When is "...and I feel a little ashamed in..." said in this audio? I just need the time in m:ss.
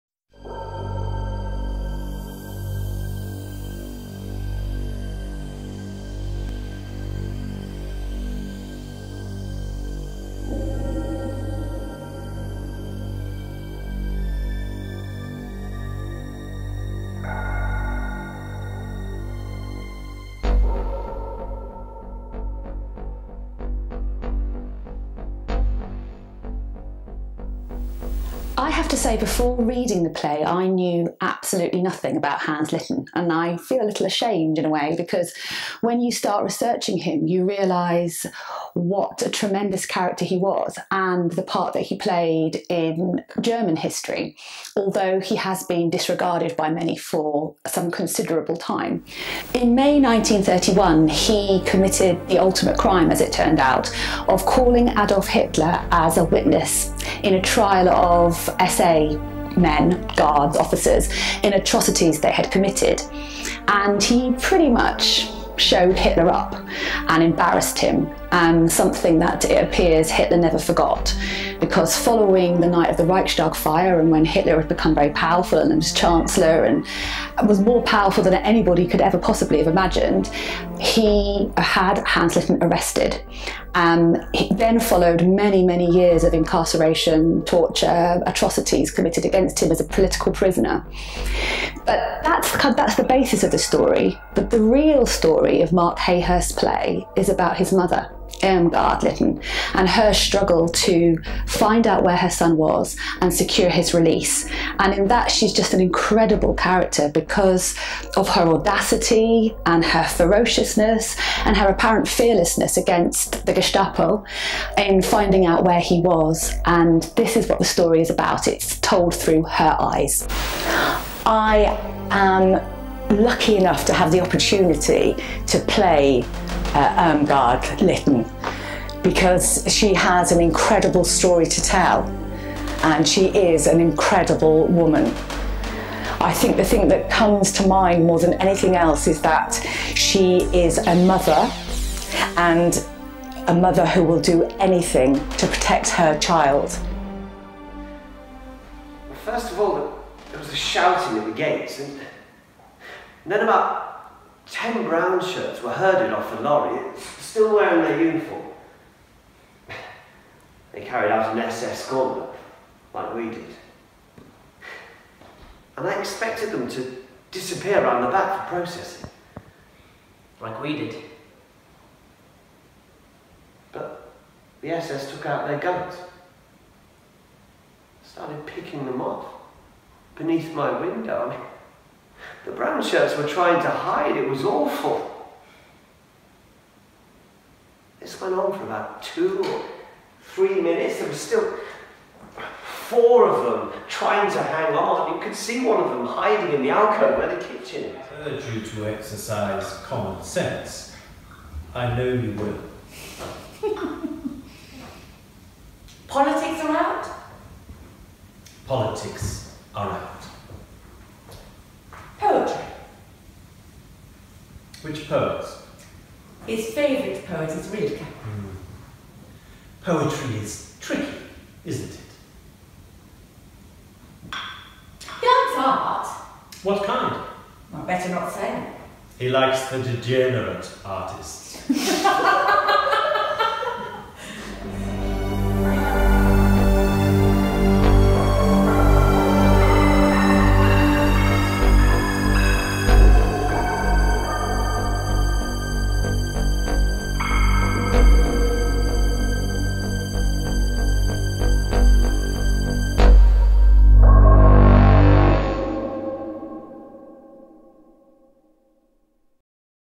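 0:33.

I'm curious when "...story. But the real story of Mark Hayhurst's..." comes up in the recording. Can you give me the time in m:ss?
1:33.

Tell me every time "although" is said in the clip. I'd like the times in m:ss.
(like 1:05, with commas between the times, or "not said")
0:44.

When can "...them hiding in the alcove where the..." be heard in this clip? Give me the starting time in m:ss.
3:15.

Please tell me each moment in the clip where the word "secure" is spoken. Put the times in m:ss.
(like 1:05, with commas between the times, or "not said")
1:43.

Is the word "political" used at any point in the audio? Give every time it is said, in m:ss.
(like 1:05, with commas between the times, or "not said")
1:29.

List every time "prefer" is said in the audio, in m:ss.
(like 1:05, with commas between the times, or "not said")
not said.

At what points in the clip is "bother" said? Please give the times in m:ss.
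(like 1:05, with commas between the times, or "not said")
not said.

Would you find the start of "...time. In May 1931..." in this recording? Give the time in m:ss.
0:48.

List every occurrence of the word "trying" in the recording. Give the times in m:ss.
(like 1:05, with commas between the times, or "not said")
3:03, 3:13.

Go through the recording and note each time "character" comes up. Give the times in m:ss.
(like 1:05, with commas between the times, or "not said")
0:39, 1:46.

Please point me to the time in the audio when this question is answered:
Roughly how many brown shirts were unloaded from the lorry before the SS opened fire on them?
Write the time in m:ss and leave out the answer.
2:34.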